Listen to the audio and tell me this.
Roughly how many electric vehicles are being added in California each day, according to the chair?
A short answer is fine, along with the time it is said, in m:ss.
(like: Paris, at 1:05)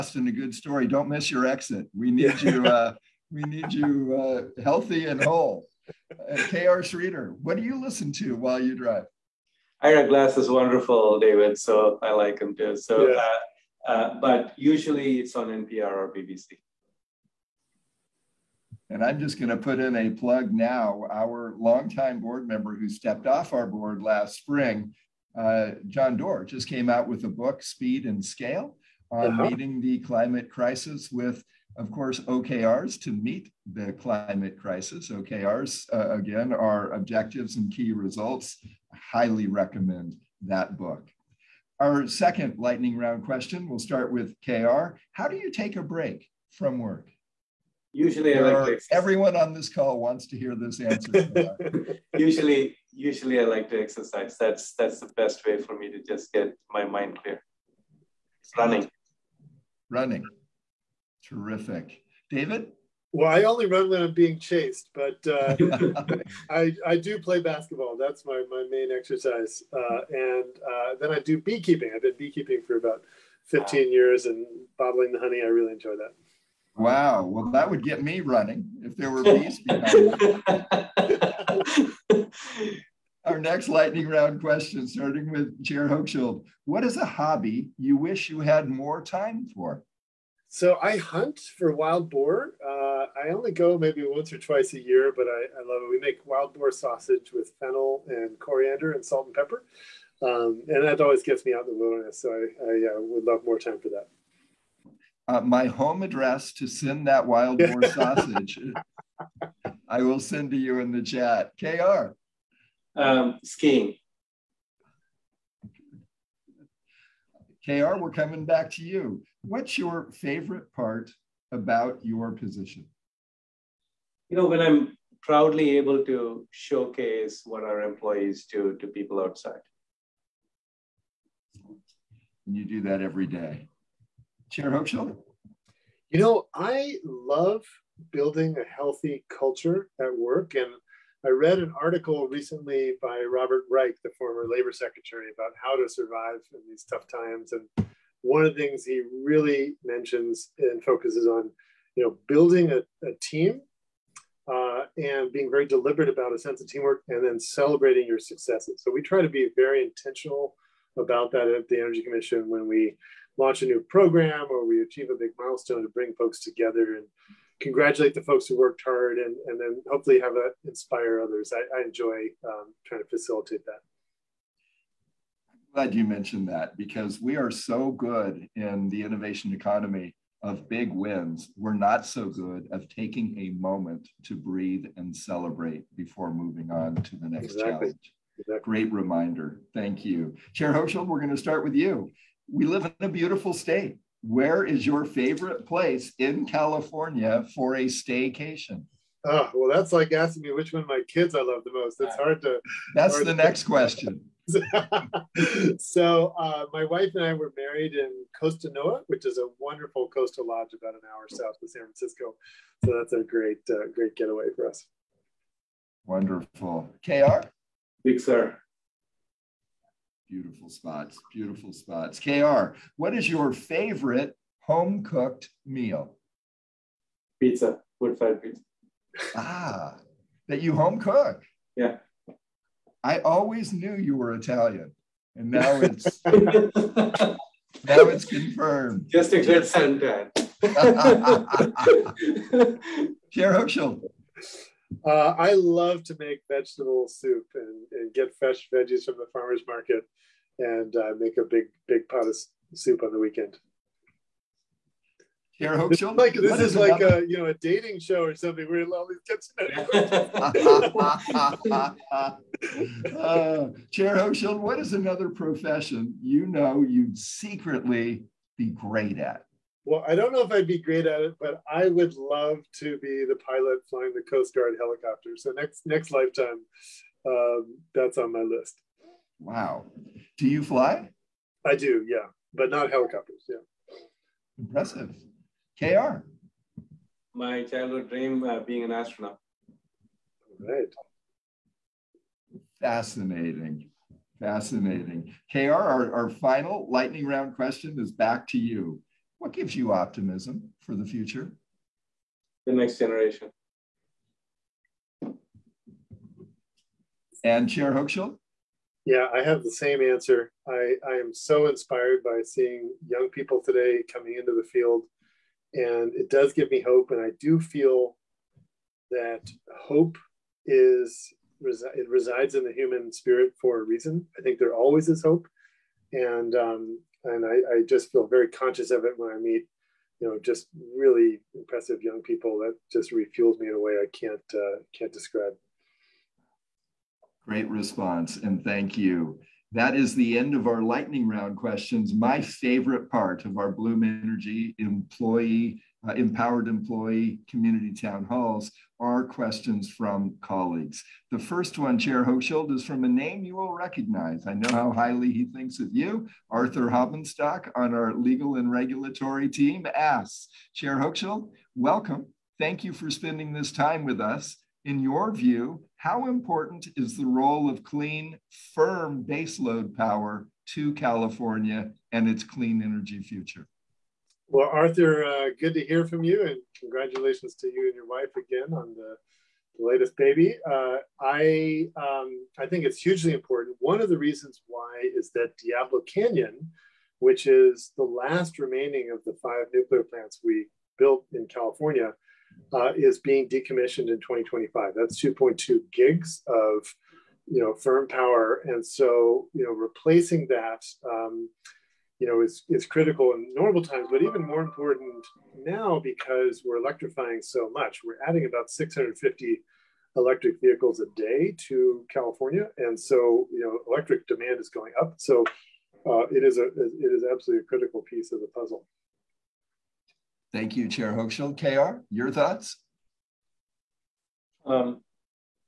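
650, at 6:48.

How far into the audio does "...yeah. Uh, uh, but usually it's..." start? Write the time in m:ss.
0:13.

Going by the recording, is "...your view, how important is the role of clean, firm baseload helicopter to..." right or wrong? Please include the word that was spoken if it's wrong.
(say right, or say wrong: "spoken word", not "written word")
wrong: "power", not "helicopter".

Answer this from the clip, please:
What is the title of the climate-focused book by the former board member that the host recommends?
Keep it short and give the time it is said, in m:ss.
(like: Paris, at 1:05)
Speed and Scale, at 0:27.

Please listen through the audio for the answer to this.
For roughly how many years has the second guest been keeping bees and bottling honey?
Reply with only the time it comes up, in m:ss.
1:13.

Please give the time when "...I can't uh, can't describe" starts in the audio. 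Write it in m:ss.
5:33.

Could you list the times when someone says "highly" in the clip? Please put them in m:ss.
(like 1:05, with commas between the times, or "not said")
0:39, 5:54.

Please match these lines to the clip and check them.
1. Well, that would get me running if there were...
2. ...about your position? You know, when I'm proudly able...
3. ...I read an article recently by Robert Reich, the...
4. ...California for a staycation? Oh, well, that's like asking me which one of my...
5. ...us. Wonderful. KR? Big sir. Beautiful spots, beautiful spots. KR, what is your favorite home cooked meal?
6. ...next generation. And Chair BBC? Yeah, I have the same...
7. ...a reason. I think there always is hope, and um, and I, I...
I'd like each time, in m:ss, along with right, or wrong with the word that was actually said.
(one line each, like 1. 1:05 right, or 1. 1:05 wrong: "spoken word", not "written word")
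1. 1:17 right
2. 2:01 right
3. 2:21 right
4. 3:16 right
5. 3:34 right
6. 5:02 wrong: "Hochschild", not "BBC"
7. 5:23 right.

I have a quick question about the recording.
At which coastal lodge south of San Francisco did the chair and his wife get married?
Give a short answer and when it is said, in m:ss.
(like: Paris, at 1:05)
Costa Noa, at 3:28.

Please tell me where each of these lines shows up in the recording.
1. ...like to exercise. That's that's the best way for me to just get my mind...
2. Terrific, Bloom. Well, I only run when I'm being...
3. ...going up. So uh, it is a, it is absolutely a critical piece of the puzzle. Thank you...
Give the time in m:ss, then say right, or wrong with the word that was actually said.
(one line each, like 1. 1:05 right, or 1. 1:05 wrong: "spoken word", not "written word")
1. 0:53 right
2. 1:01 wrong: "David", not "Bloom"
3. 6:54 right.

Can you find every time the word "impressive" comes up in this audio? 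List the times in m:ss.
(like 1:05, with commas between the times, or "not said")
4:44, 5:31.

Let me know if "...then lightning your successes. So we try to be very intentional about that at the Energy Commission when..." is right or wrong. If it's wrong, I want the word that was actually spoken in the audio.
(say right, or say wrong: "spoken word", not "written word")
wrong: "celebrating", not "lightning".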